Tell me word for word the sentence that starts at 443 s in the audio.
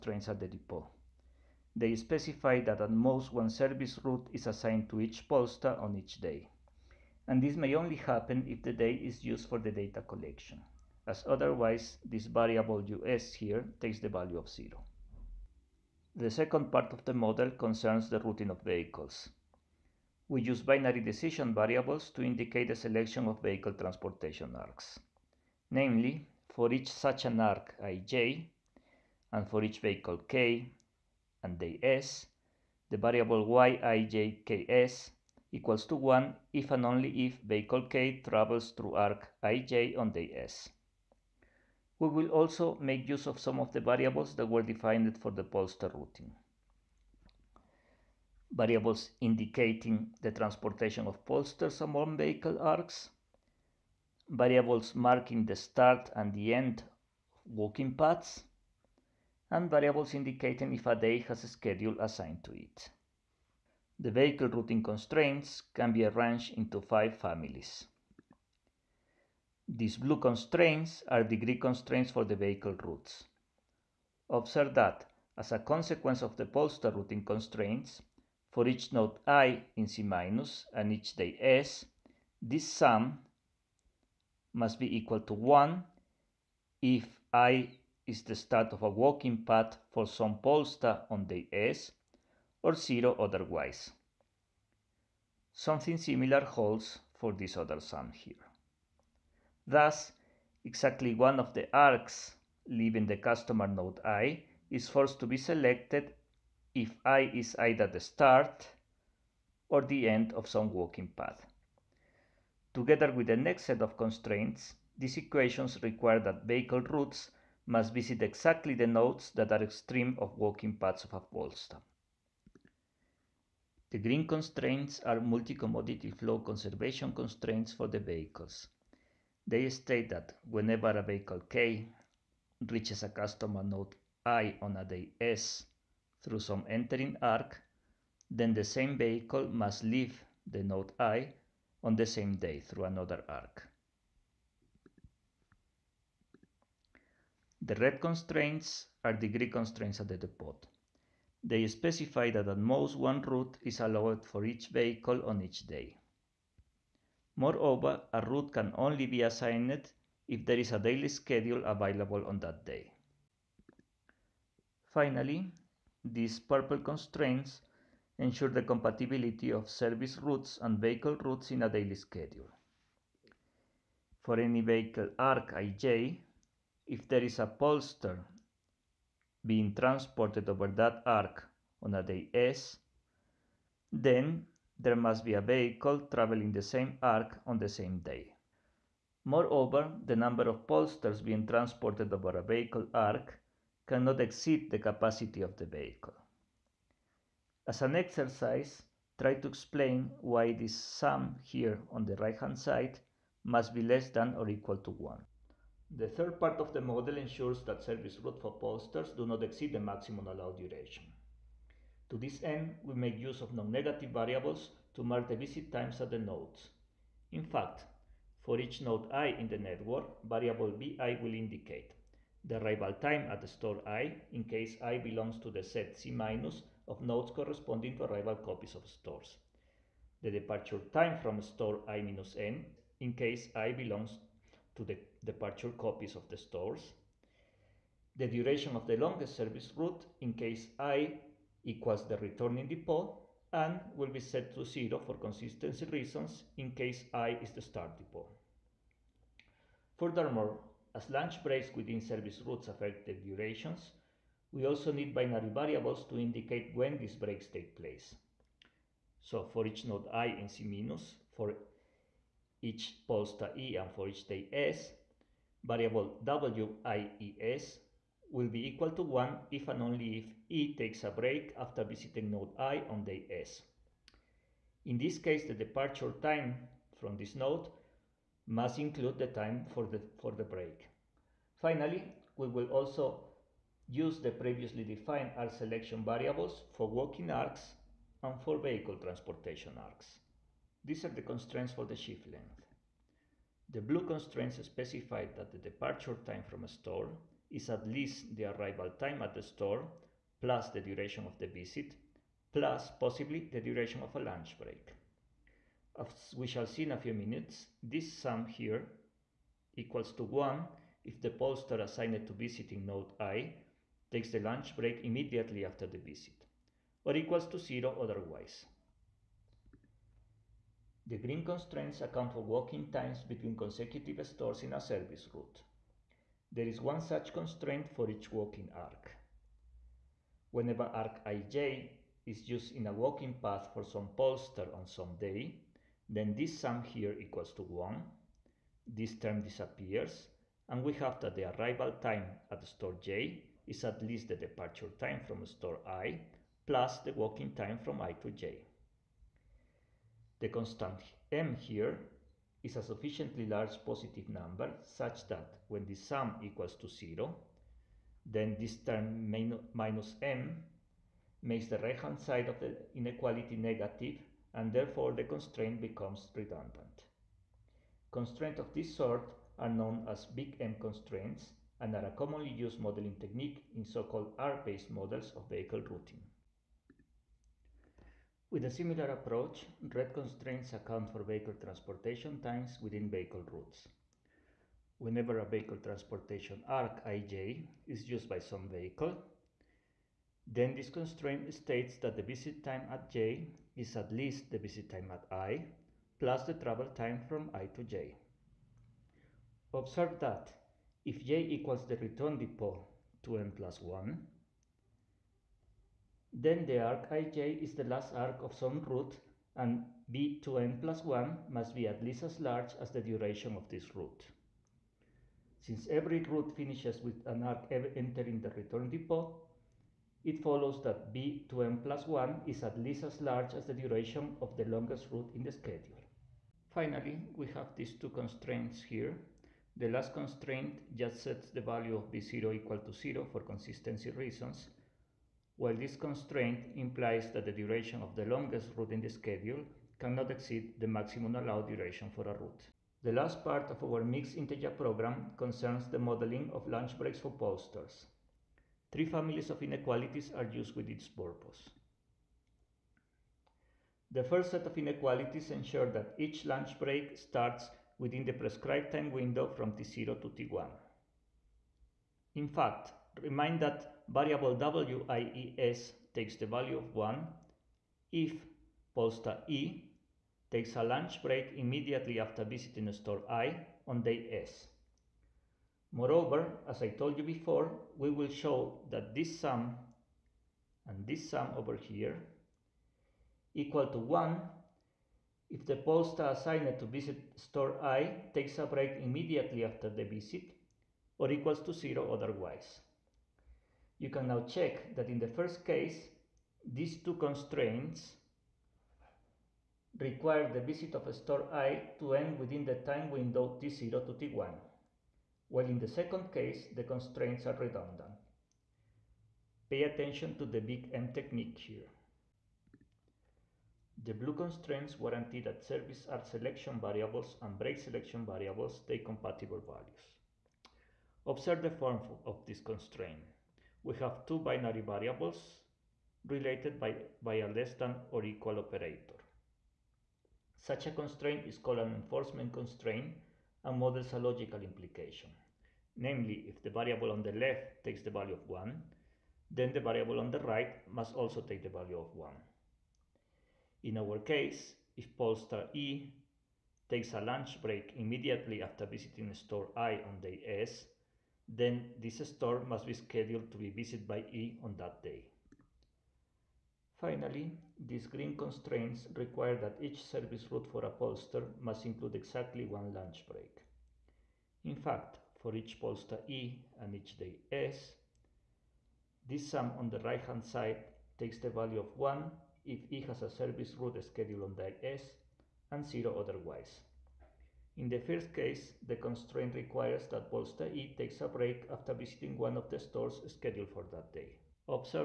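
The last part of our mixed integer program concerns the modeling of lunch breaks for pollsters.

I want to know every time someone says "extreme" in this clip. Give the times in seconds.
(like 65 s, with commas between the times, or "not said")
119 s.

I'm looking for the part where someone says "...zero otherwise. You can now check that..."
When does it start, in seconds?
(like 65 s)
491 s.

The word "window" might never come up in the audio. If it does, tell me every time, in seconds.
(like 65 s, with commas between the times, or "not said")
459 s, 503 s.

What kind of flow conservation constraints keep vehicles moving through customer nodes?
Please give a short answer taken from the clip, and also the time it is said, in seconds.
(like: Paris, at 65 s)
Multi-commodity, at 125 s.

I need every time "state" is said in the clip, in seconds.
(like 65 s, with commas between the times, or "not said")
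129 s, 391 s.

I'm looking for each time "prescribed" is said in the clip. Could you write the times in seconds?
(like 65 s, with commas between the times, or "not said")
458 s.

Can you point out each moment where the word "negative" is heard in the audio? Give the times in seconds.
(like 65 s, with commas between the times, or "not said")
213 s, 363 s.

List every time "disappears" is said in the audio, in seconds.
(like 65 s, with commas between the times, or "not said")
339 s.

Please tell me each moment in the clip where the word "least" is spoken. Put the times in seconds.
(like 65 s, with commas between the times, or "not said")
297 s, 344 s, 394 s, 412 s, 422 s.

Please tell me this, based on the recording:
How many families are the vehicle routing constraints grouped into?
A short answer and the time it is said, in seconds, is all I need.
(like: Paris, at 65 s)
5, at 66 s.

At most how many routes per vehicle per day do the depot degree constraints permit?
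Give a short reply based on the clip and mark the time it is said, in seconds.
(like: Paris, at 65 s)
1, at 152 s.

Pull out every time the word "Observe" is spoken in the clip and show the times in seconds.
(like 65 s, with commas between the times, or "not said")
74 s, 399 s, 521 s.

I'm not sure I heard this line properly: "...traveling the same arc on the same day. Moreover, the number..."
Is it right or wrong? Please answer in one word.
right.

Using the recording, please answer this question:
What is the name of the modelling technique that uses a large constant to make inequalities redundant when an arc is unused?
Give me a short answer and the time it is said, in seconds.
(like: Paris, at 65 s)
Big M constraints, at 370 s.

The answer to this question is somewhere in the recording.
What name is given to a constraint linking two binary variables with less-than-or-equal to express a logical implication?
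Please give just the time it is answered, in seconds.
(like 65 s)
531 s.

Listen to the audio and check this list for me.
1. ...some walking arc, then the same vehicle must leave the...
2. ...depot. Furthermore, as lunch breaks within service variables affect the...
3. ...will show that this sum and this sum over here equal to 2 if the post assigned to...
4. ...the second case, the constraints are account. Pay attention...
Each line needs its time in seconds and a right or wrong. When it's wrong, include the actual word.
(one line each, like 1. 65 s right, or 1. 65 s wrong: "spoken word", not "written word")
1. 136 s wrong: "entering", not "walking"
2. 247 s wrong: "routes", not "variables"
3. 478 s wrong: "1", not "2"
4. 505 s wrong: "redundant", not "account".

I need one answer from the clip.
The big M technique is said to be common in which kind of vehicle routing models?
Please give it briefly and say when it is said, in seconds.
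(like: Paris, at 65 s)
Arc-based models, at 374 s.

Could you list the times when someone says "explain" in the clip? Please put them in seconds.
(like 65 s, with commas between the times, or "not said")
199 s.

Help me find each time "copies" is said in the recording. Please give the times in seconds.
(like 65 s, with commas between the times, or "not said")
228 s, 235 s.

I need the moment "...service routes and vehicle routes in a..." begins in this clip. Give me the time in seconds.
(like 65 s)
169 s.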